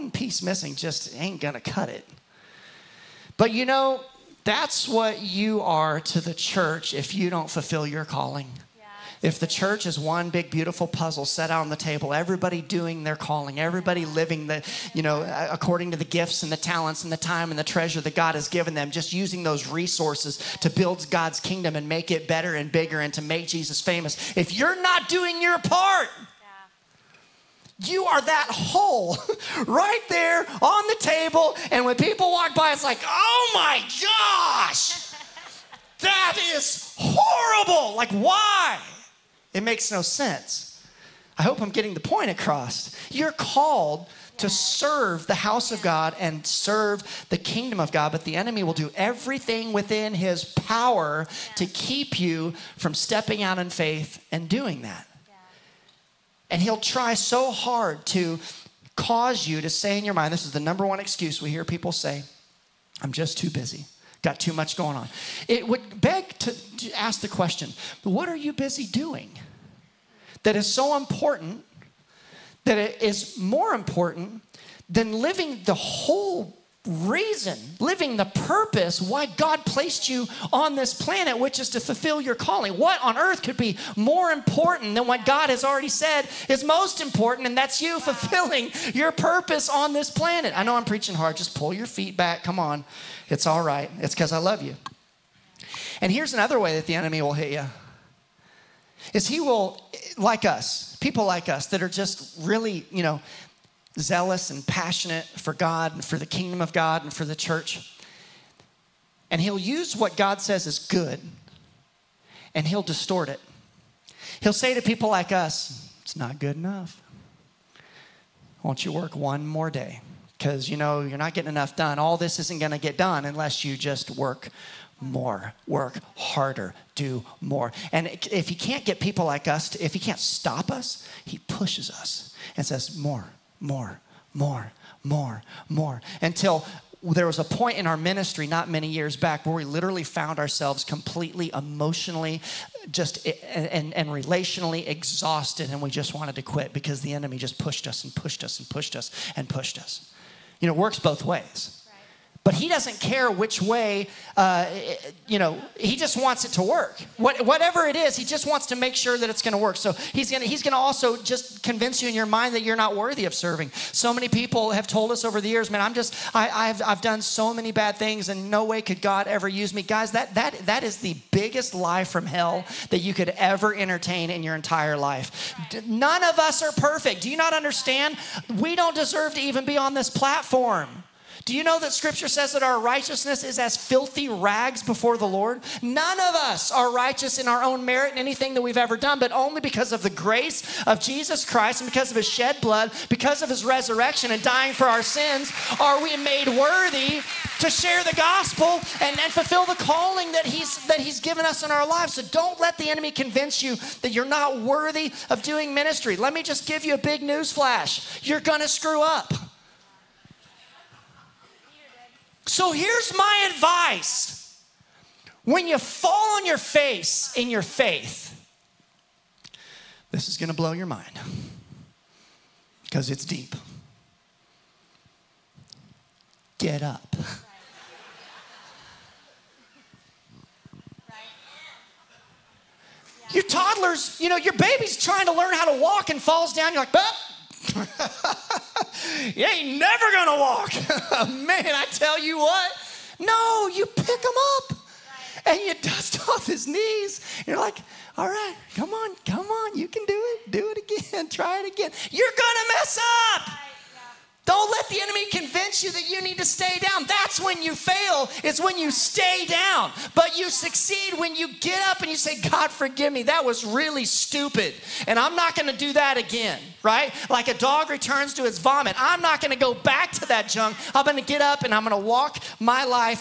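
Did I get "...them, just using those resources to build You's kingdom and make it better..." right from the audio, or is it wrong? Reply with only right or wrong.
wrong.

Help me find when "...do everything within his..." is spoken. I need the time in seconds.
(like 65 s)
48 s.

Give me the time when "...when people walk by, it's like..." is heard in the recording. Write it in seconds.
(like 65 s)
31 s.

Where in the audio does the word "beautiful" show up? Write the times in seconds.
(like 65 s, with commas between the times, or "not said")
10 s.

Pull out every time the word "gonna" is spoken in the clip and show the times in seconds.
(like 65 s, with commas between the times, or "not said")
1 s, 208 s, 240 s, 252 s.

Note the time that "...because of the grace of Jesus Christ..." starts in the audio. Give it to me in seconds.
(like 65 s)
189 s.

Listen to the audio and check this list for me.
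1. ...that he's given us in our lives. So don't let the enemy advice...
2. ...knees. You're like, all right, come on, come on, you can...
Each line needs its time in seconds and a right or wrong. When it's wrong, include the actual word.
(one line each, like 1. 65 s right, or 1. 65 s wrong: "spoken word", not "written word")
1. 200 s wrong: "convince", not "advice"
2. 246 s right.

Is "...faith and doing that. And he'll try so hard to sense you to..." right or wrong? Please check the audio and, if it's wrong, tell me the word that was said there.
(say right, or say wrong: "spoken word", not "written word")
wrong: "cause", not "sense".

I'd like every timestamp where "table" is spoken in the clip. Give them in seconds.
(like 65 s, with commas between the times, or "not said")
11 s, 30 s.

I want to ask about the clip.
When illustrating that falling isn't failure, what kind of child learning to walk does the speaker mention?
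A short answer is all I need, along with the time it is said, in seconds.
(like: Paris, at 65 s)
Toddlers, at 233 s.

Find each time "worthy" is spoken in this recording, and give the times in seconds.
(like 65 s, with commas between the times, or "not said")
162 s, 196 s, 204 s.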